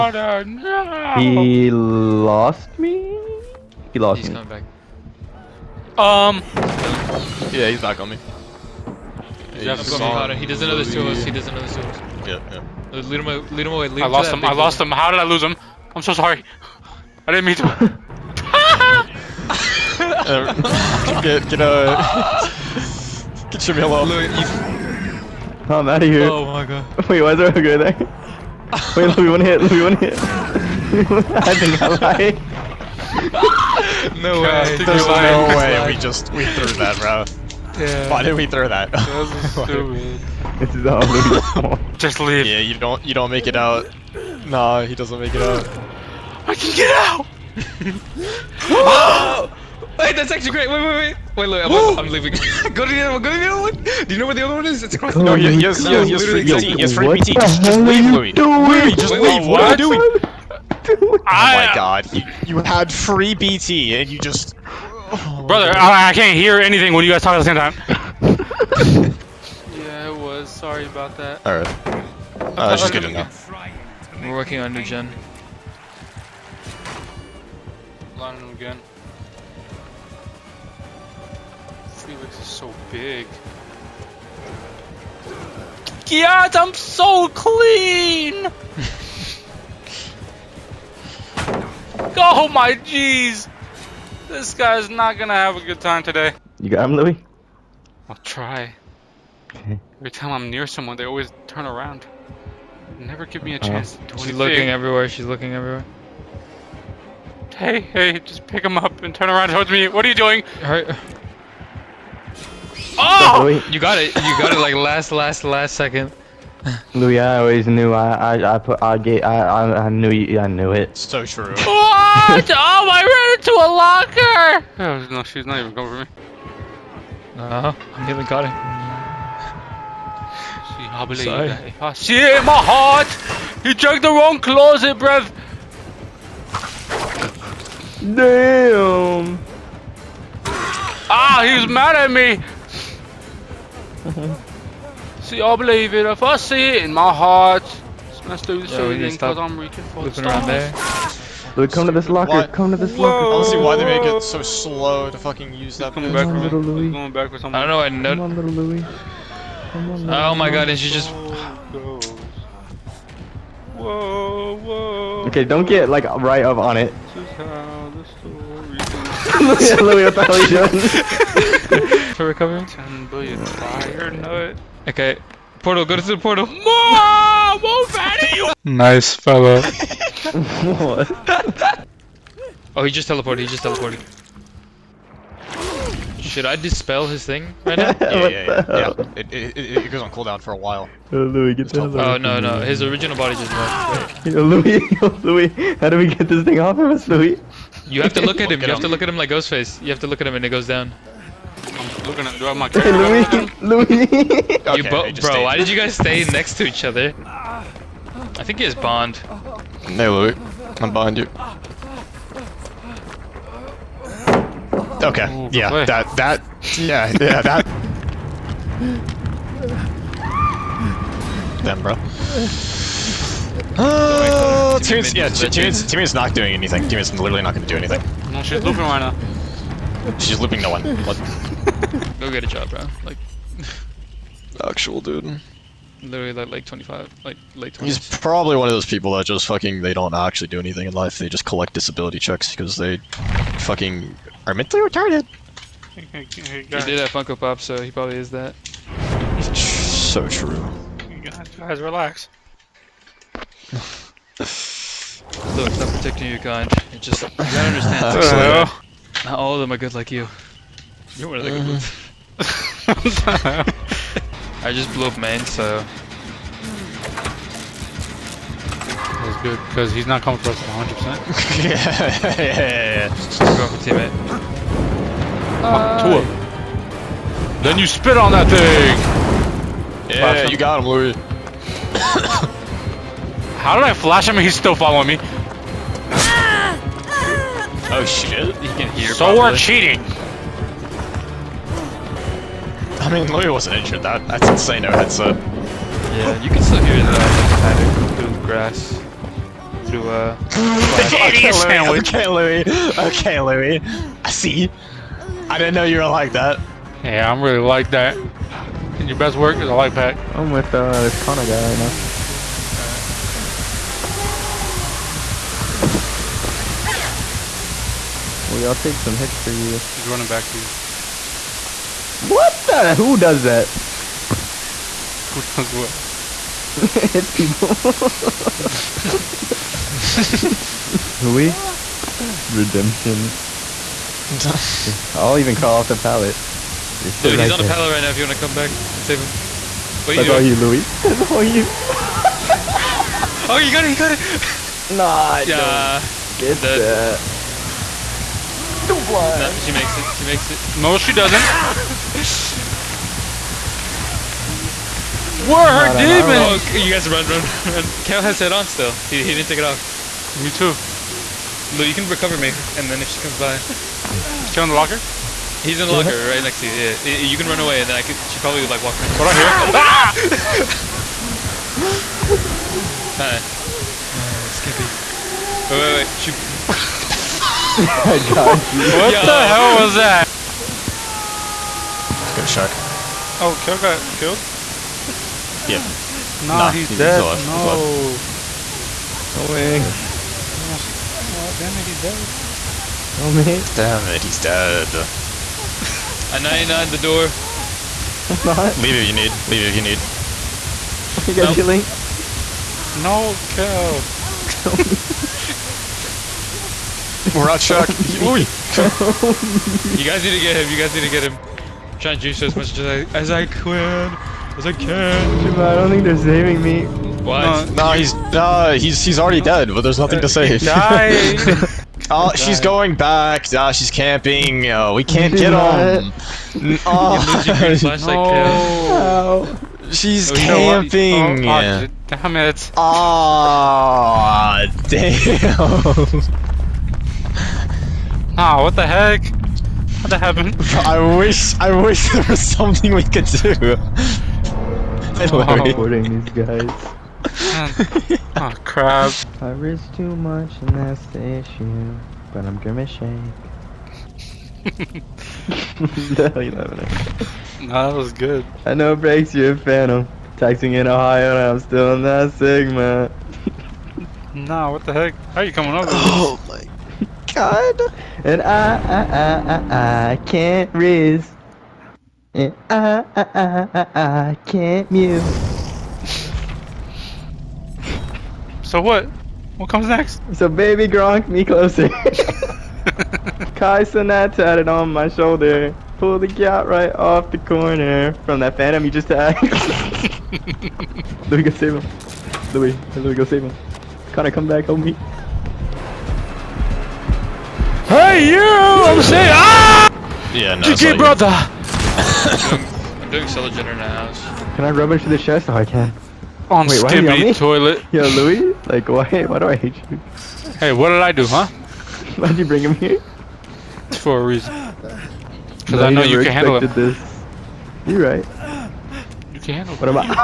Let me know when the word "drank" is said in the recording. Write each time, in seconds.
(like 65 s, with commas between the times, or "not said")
133 s.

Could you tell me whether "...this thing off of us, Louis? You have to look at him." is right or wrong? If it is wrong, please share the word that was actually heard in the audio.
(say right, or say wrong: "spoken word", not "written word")
right.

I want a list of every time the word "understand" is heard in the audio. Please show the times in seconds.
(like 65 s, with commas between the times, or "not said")
257 s.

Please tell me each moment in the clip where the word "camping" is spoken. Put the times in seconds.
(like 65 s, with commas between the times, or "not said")
423 s, 430 s.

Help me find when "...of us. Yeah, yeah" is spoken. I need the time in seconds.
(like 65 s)
11 s.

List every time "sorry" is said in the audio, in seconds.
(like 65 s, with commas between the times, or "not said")
16 s, 70 s, 131 s.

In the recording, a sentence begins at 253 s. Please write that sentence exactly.
Look, it's not protecting you, kind.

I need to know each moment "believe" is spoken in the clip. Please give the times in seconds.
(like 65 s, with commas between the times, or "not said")
131 s, 145 s.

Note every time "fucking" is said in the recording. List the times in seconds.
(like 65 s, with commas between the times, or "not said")
155 s, 239 s, 243 s.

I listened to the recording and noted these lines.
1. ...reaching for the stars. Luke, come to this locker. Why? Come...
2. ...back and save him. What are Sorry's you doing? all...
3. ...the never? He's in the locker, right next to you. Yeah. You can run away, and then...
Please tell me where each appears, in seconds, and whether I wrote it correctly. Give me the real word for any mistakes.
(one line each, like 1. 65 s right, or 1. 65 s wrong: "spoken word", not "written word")
1. 149 s right
2. 338 s wrong: "That", not "Sorry"
3. 364 s wrong: "locker", not "never".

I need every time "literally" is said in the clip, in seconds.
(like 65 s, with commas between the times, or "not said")
227 s, 236 s.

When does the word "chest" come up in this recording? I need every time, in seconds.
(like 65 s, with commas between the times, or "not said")
505 s.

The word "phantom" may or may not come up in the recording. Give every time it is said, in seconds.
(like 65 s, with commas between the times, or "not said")
459 s, 488 s.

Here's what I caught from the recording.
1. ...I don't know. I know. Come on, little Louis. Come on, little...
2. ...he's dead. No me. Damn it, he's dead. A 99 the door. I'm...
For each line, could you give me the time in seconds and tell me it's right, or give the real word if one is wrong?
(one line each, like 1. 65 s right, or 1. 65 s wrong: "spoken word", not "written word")
1. 157 s right
2. 391 s right.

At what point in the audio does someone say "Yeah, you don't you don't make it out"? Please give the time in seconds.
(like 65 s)
42 s.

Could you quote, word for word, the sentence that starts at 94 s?
This guy's not gonna have a good time today.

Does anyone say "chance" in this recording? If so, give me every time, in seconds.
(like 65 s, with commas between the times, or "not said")
103 s.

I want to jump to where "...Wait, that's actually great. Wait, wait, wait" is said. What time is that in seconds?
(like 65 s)
49 s.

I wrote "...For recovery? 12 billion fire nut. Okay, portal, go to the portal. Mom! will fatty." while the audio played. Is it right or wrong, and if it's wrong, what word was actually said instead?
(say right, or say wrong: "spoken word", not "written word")
wrong: "10", not "12".